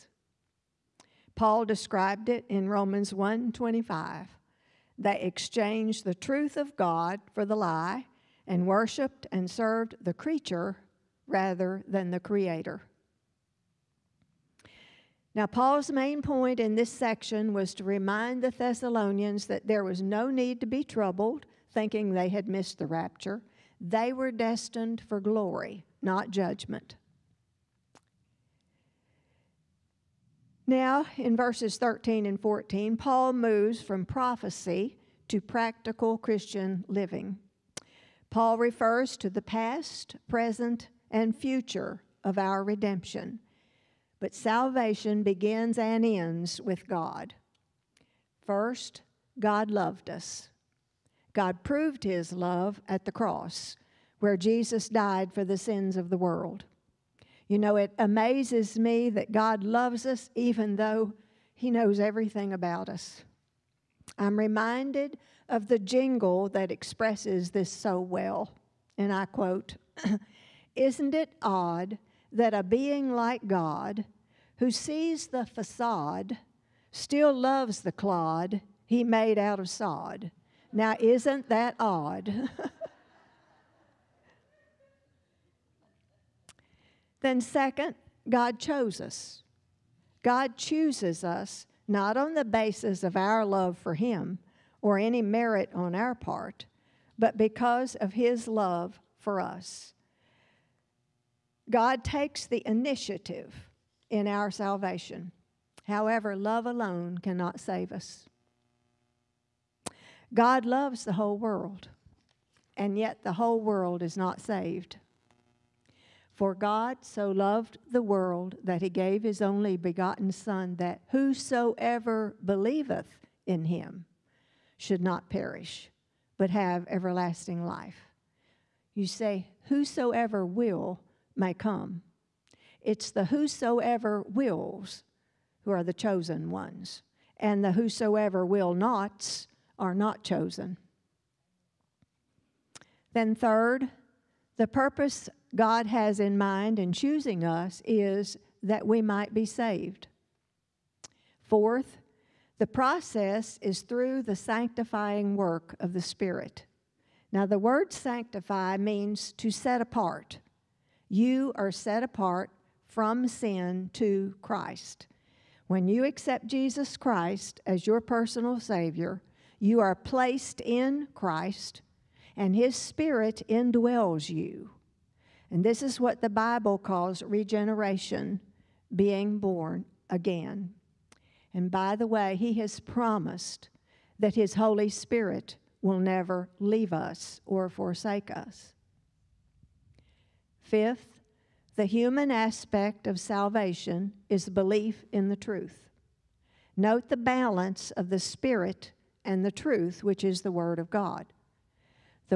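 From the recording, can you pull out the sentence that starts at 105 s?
However, love alone cannot save us.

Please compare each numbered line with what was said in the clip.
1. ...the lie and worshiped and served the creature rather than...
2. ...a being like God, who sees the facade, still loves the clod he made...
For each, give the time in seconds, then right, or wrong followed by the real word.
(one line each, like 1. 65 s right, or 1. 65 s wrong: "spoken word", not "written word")
1. 7 s right
2. 72 s right.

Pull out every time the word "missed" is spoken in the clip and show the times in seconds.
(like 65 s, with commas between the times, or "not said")
22 s.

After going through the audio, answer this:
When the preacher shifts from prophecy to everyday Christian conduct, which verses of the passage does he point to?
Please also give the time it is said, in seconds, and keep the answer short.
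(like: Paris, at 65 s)
Verses 13 and 14, at 31 s.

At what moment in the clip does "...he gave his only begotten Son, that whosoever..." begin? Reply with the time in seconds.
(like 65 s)
118 s.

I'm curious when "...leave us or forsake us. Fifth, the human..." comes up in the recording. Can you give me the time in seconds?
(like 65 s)
186 s.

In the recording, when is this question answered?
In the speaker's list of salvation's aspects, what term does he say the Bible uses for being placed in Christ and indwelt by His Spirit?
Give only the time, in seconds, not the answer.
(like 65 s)
177 s.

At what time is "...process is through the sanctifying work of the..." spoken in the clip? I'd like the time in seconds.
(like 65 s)
152 s.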